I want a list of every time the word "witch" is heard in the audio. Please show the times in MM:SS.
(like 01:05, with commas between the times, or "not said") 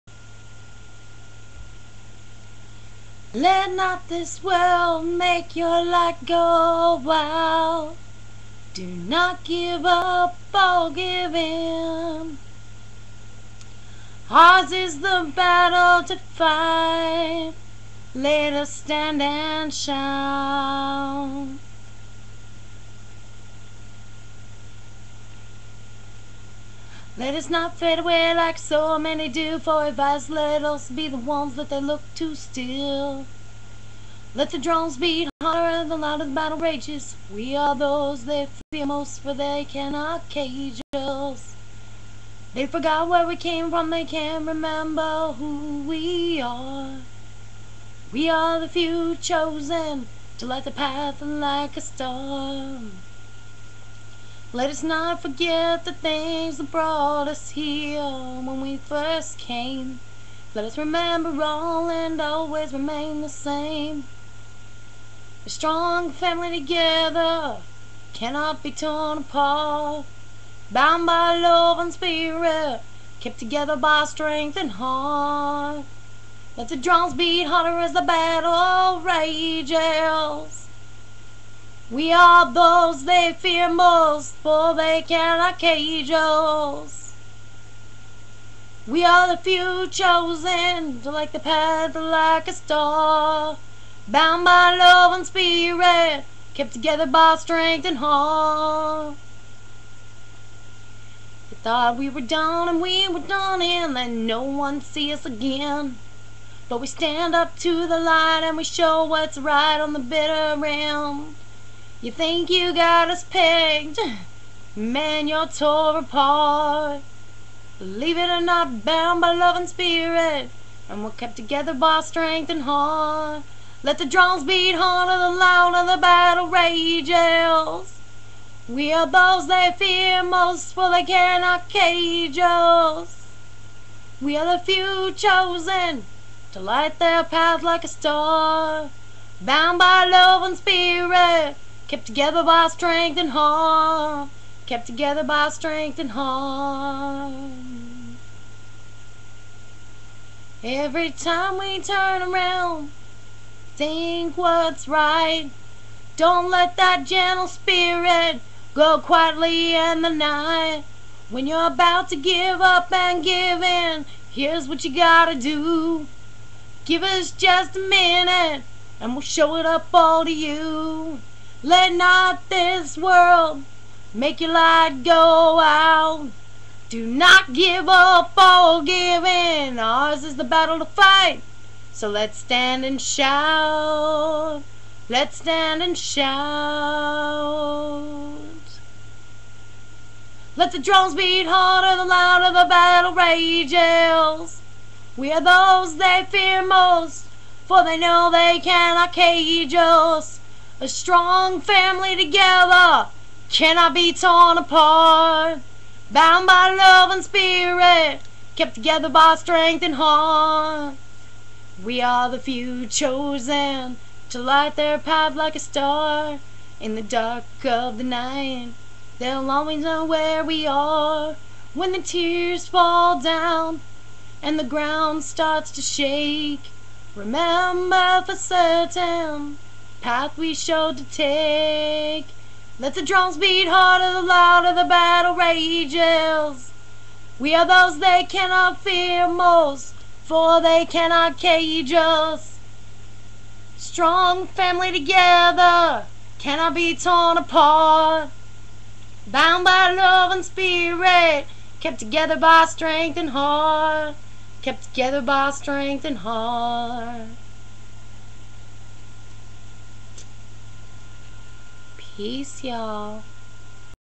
not said.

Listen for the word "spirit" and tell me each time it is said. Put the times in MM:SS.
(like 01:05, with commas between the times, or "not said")
01:11, 01:35, 01:59, 02:20, 02:37, 03:27, 04:10.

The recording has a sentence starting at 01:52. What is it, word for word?
You think you got us pegged, man, you're tore apart.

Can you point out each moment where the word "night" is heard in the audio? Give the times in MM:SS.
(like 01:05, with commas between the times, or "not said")
02:40, 03:38.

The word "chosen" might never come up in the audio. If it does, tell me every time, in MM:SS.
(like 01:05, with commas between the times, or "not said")
00:49, 01:29, 02:15, 03:32.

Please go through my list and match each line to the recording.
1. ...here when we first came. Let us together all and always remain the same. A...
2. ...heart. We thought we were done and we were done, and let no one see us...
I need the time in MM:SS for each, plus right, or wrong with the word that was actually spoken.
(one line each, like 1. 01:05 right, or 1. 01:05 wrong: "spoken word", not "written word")
1. 00:57 wrong: "remember", not "together"
2. 01:37 right.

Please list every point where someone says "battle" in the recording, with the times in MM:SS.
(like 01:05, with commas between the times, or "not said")
00:15, 00:36, 01:18, 02:06, 03:00, 03:12, 03:54.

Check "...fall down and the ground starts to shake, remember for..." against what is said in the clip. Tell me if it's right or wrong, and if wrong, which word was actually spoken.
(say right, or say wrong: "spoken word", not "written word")
right.